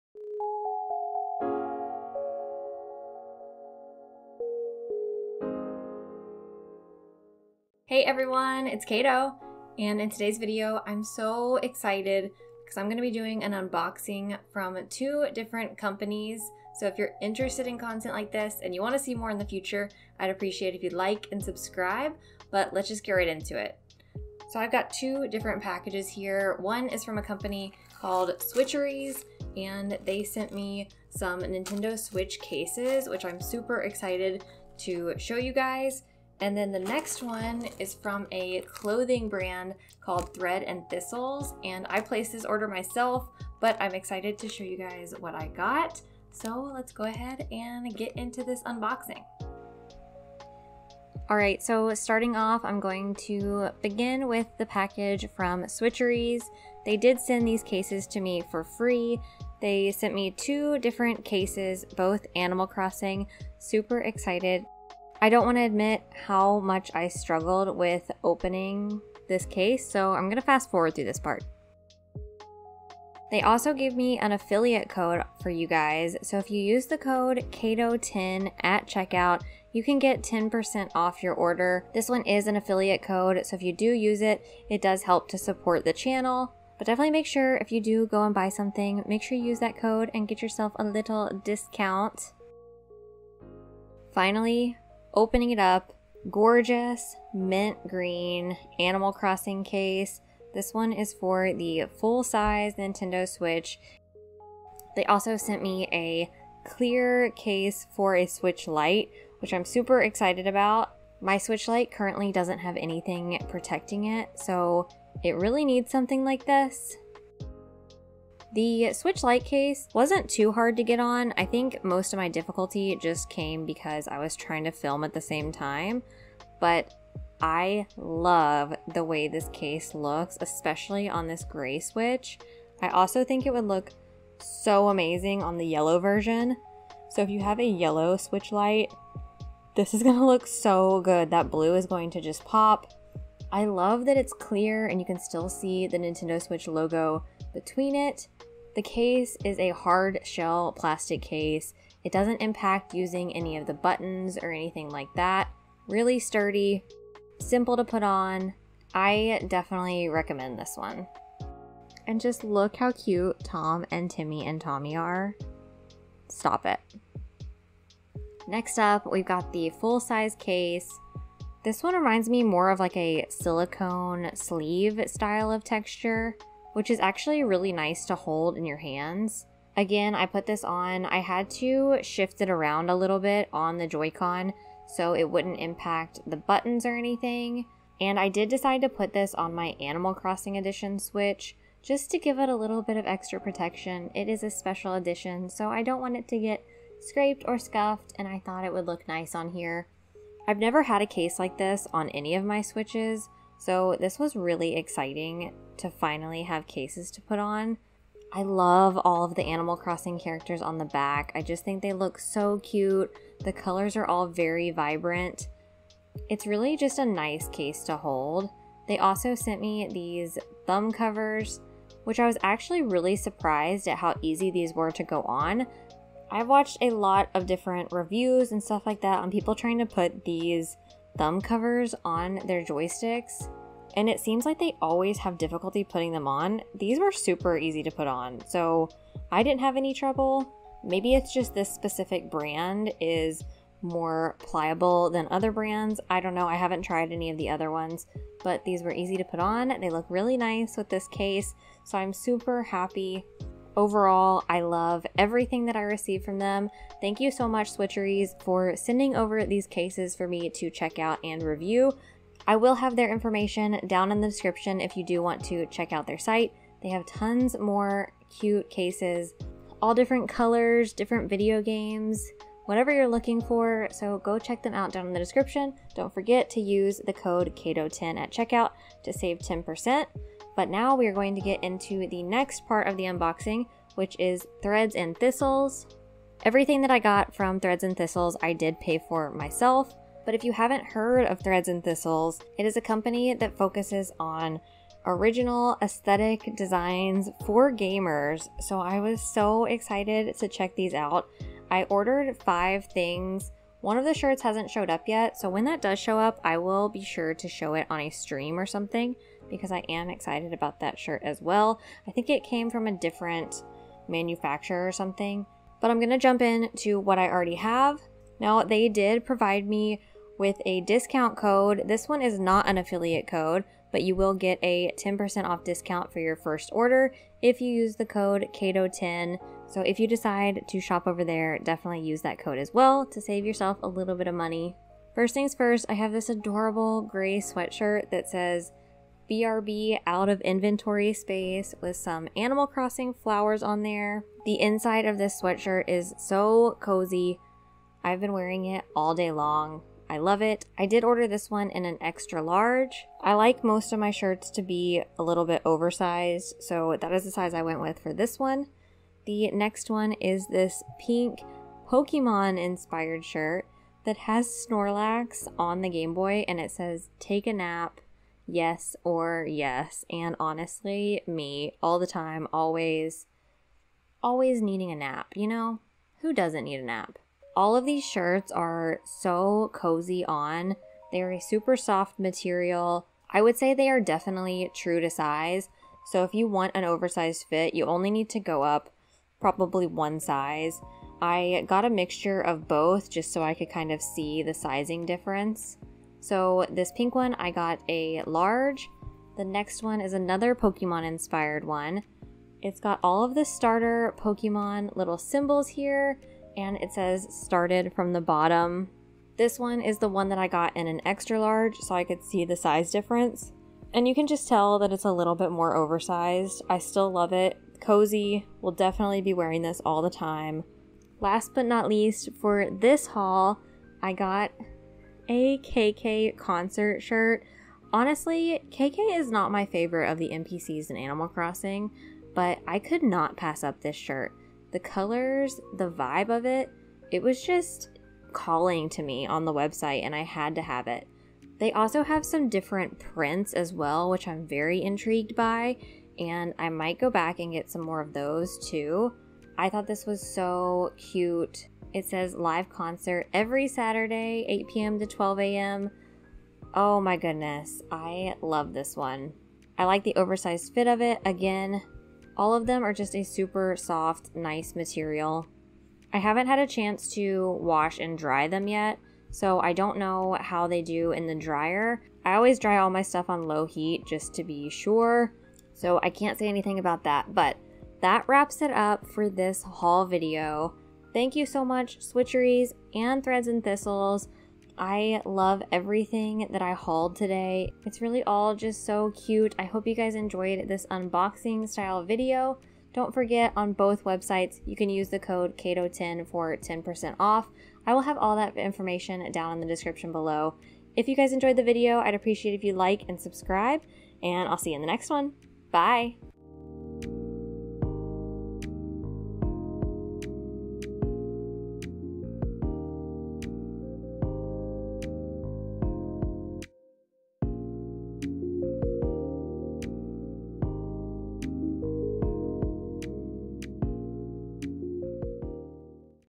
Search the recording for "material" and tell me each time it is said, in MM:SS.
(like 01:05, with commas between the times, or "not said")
06:22, 07:44.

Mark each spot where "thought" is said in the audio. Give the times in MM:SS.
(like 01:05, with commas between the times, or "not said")
03:18, 07:29.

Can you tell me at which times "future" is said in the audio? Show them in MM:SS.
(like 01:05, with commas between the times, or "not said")
00:19.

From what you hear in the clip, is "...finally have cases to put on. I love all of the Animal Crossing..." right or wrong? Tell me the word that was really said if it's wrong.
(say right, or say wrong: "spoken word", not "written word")
right.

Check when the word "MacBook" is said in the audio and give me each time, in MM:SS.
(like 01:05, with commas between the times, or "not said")
not said.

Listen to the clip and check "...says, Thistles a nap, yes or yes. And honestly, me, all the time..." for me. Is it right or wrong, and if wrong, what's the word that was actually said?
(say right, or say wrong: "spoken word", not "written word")
wrong: "Take", not "Thistles".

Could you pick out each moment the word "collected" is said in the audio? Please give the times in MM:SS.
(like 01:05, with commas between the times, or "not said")
not said.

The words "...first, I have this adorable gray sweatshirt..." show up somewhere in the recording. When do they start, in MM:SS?
05:35.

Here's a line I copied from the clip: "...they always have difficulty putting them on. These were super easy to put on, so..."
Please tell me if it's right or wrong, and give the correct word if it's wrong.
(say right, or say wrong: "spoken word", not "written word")
right.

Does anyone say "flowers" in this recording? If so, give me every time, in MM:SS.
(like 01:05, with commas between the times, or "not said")
05:43.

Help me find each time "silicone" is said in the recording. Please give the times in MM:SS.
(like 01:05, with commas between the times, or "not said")
02:53.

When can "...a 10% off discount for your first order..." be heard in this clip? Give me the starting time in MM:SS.
05:24.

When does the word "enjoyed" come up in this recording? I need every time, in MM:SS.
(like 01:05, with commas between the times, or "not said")
08:10, 08:21.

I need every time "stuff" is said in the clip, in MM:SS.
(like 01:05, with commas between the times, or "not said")
03:48, 07:53.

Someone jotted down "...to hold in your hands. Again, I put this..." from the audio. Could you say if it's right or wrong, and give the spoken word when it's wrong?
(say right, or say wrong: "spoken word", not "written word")
right.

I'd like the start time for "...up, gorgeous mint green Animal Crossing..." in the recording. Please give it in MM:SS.
01:35.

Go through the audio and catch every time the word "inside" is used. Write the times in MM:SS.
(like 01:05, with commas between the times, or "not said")
05:44.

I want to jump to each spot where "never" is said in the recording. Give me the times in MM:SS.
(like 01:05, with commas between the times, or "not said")
03:20.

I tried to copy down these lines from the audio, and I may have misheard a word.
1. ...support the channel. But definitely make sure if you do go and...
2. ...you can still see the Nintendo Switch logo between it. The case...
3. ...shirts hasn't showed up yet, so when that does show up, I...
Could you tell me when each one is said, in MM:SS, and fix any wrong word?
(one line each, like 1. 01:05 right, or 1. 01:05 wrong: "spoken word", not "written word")
1. 01:25 right
2. 02:24 right
3. 05:04 right.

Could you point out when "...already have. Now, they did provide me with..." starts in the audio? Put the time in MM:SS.
05:17.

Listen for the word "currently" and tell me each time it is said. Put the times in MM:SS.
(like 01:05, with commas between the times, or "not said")
01:51.